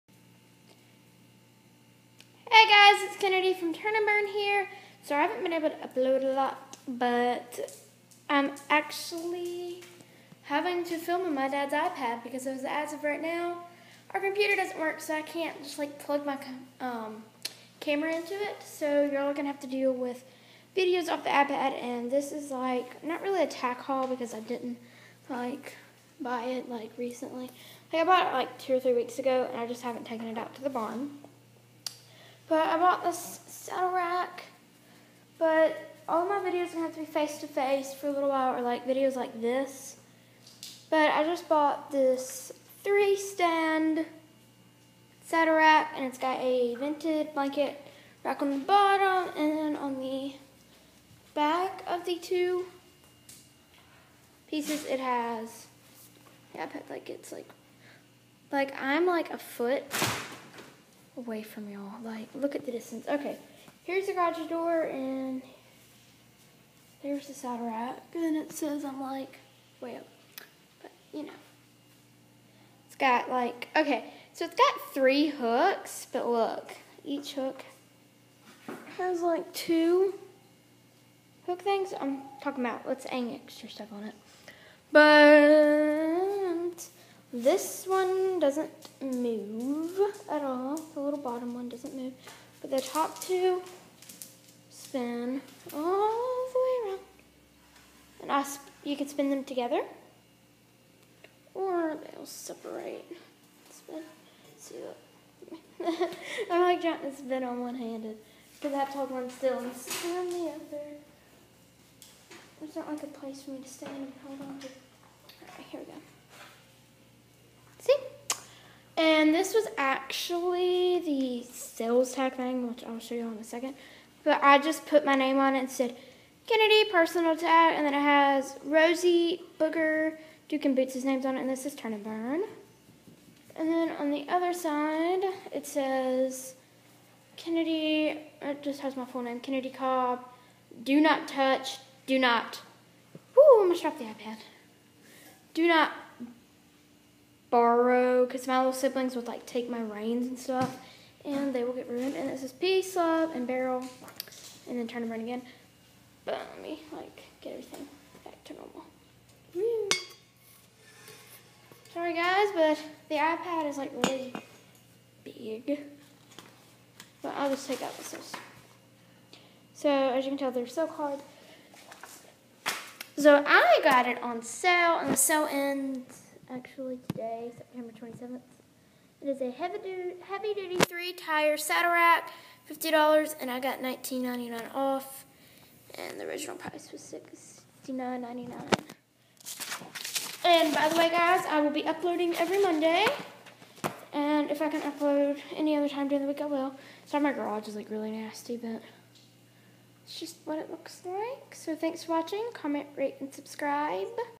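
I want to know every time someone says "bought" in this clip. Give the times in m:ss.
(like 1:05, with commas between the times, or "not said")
0:28, 0:32, 0:41.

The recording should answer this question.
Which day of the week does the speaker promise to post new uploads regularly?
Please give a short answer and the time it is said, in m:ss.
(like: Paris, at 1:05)
Monday, at 3:12.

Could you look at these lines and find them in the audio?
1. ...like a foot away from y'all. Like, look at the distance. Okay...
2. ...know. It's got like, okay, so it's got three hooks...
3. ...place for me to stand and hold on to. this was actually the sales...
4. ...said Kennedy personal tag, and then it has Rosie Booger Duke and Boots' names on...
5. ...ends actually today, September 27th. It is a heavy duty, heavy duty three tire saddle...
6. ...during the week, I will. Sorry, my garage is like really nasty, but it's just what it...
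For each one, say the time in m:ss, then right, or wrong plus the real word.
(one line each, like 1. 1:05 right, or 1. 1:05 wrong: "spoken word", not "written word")
1. 0:59 right
2. 1:11 right
3. 1:53 right
4. 2:05 right
5. 2:55 right
6. 3:16 right.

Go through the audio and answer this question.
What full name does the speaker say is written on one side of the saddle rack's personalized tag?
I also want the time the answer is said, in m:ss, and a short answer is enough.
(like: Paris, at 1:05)
Kennedy Cobb, at 2:19.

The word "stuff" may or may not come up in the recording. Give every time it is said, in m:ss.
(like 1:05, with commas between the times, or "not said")
1:23, 2:30.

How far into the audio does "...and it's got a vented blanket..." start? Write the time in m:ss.
0:45.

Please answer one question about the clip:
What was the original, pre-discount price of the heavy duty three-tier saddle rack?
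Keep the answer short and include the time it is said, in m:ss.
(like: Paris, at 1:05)
$69.99, at 3:07.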